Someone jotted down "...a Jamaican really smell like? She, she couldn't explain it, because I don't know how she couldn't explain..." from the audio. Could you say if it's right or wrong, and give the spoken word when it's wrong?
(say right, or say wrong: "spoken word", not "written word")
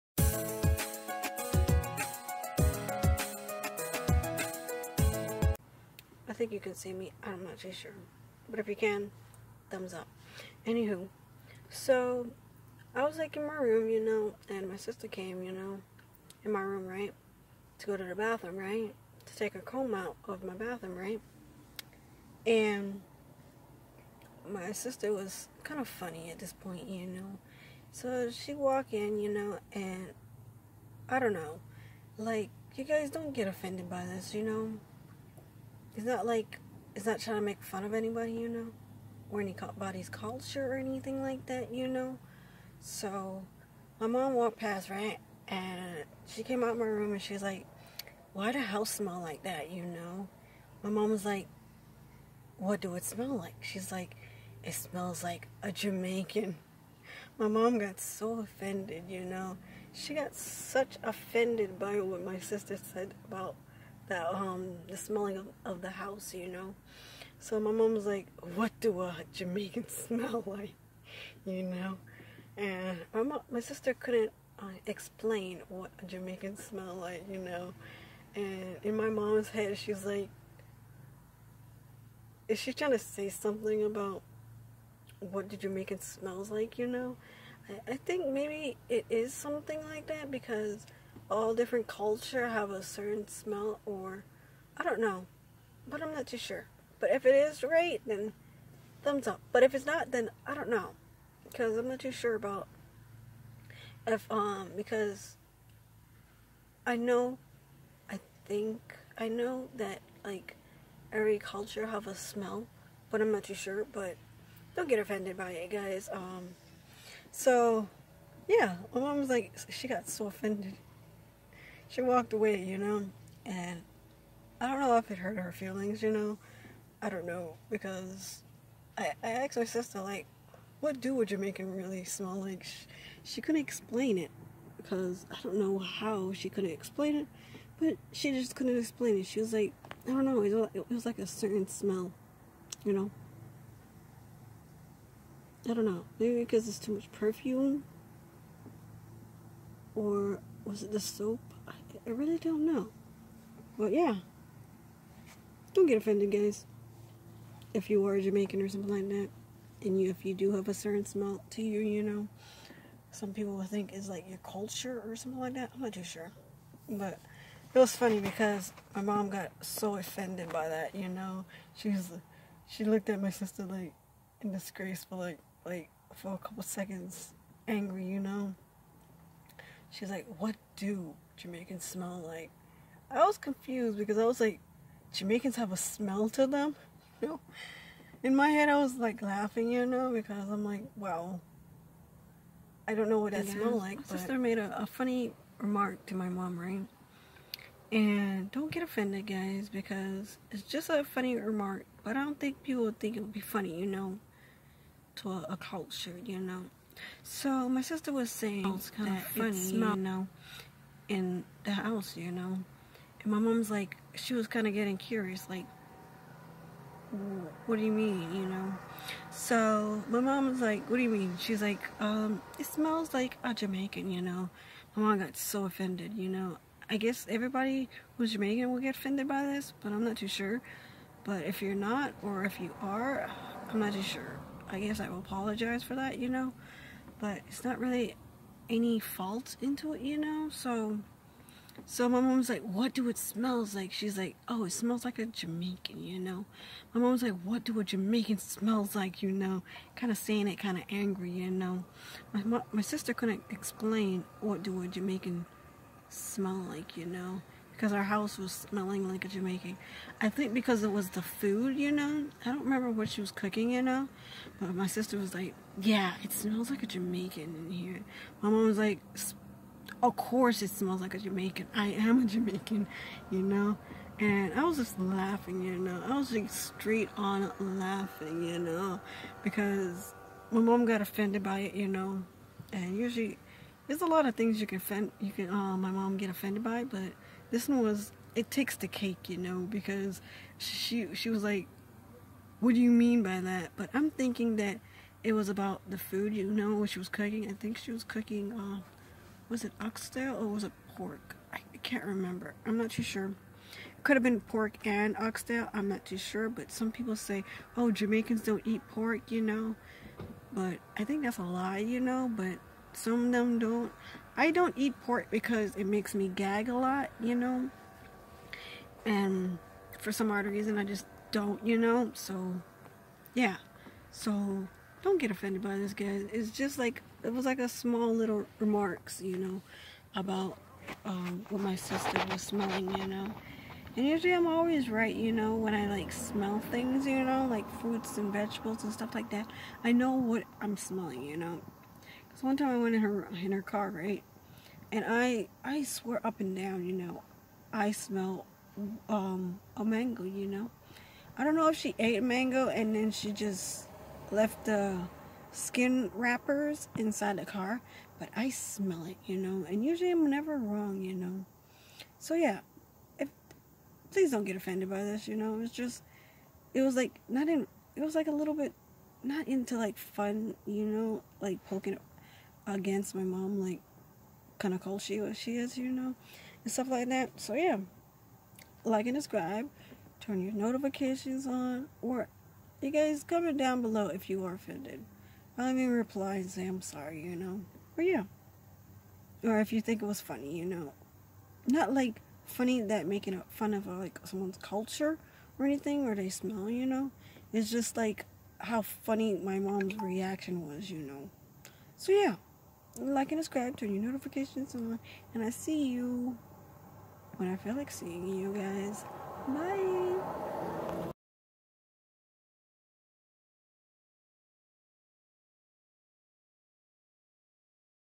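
right.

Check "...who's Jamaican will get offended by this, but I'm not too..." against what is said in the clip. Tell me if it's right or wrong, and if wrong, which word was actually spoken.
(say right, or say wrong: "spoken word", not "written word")
right.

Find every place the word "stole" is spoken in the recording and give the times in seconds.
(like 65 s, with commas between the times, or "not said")
not said.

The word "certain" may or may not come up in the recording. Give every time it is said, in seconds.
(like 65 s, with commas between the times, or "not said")
92 s, 141 s, 160 s.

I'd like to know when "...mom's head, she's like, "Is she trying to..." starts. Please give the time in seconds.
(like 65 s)
79 s.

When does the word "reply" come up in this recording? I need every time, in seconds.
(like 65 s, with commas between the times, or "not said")
385 s.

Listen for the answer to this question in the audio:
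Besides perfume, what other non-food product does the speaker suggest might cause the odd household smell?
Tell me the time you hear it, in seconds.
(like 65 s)
150 s.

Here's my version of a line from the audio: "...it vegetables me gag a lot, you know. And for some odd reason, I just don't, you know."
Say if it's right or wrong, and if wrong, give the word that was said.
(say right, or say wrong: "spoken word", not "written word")
wrong: "makes", not "vegetables".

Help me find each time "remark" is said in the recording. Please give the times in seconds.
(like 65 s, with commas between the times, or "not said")
195 s, 201 s, 328 s.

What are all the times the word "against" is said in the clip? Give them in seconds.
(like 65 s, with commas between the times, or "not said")
372 s.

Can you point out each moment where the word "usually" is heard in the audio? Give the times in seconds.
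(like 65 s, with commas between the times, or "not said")
282 s, 334 s, 359 s.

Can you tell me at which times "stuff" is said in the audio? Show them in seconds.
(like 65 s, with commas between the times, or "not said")
338 s, 376 s.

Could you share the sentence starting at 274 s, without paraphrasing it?
And I was just laughing, you know.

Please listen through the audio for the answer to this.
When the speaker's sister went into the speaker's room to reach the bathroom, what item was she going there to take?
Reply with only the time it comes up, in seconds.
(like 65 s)
19 s.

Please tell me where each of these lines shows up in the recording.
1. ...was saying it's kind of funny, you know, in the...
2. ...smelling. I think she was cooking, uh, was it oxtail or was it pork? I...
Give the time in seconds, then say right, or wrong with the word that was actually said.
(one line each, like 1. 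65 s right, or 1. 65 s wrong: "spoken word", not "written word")
1. 208 s right
2. 297 s wrong: "cooking", not "smelling".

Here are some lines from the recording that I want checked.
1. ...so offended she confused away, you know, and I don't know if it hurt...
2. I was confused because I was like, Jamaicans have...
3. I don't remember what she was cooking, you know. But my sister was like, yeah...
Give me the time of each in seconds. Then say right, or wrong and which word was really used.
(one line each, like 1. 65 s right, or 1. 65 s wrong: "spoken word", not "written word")
1. 120 s wrong: "walked", not "confused"
2. 183 s right
3. 262 s right.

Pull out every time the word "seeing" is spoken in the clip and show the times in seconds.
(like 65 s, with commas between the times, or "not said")
407 s.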